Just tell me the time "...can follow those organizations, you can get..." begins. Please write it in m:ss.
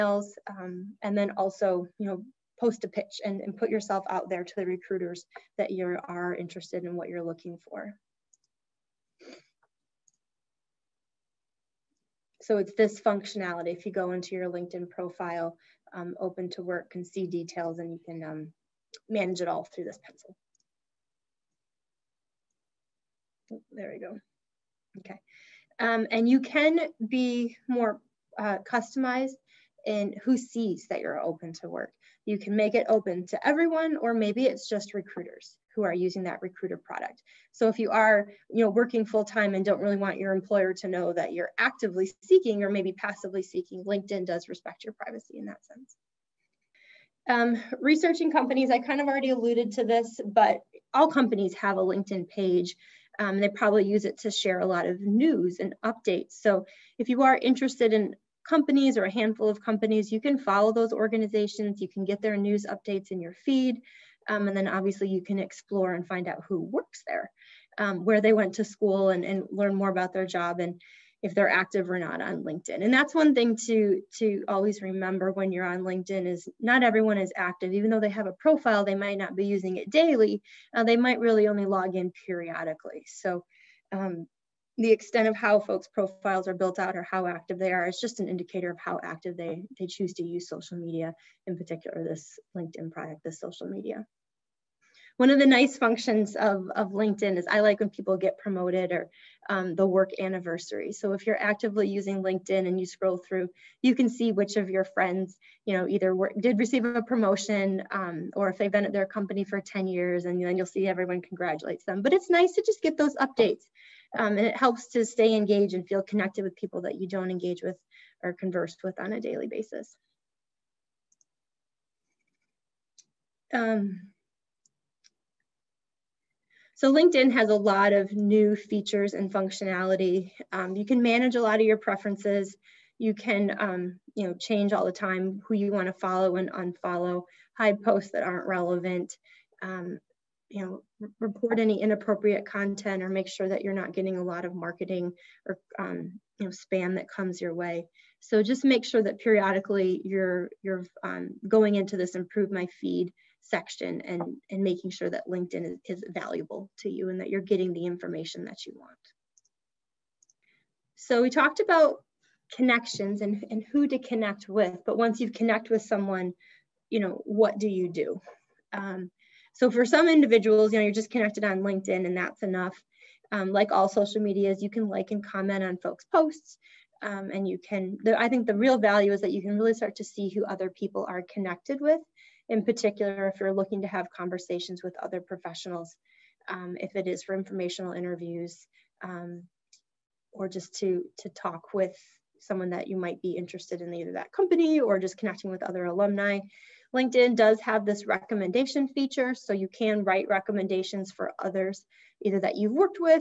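1:00.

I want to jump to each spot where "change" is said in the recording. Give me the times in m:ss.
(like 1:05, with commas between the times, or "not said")
2:14.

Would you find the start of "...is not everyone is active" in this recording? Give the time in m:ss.
1:16.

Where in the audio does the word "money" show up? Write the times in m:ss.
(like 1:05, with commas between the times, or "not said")
not said.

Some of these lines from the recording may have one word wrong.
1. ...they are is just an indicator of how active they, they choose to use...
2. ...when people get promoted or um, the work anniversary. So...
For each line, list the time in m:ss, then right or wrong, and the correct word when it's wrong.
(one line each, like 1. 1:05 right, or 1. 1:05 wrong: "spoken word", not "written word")
1. 1:27 right
2. 1:37 right.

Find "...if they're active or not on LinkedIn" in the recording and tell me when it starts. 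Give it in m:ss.
1:11.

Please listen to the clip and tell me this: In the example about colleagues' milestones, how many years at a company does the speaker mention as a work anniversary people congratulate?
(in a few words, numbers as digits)
10.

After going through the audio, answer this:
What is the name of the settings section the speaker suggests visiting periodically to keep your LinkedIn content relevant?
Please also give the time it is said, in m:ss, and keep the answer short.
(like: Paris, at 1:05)
Improve my feed, at 2:32.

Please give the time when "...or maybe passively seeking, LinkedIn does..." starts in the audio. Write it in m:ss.
0:42.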